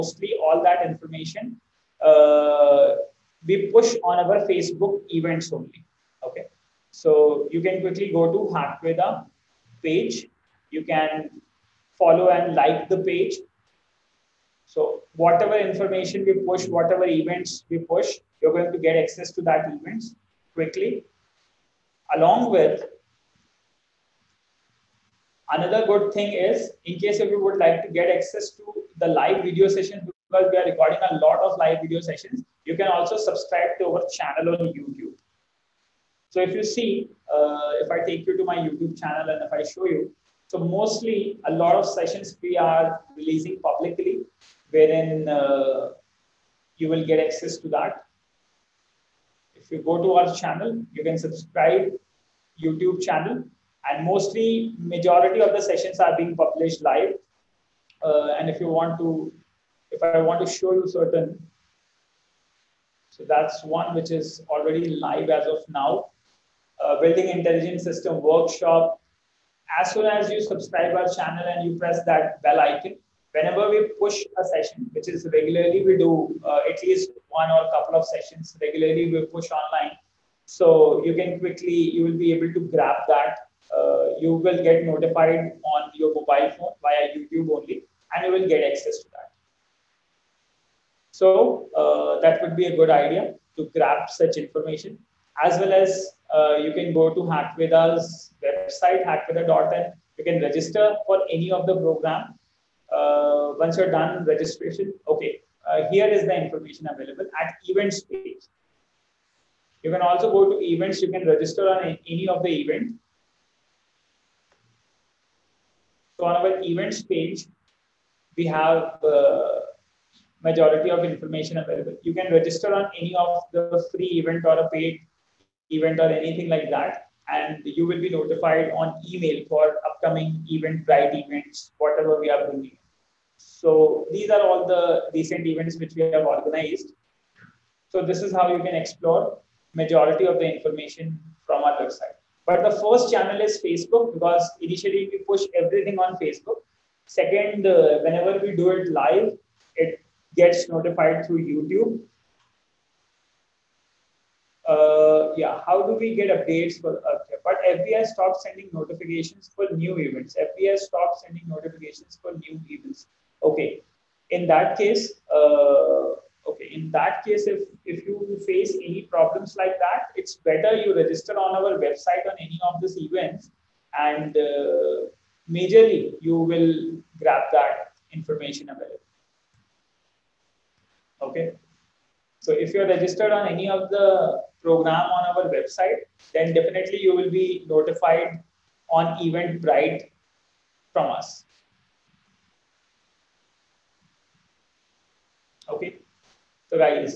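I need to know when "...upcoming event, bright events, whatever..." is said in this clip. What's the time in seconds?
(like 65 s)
129 s.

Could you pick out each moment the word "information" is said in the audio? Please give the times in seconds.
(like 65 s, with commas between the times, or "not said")
0 s, 15 s, 94 s, 106 s, 121 s, 140 s, 178 s.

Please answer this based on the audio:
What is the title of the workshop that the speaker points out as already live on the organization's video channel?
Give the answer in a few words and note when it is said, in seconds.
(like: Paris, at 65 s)
Building intelligent system workshop, at 66 s.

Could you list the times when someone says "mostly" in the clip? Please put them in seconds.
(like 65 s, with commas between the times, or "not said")
40 s, 54 s.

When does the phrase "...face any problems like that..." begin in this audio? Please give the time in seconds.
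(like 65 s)
168 s.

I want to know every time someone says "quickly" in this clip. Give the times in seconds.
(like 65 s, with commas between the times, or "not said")
7 s, 20 s, 81 s.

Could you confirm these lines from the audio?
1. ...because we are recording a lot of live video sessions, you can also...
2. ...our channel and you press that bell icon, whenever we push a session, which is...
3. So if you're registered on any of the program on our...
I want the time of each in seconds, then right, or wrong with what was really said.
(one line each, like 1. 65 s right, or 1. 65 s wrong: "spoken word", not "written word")
1. 30 s right
2. 70 s right
3. 182 s right.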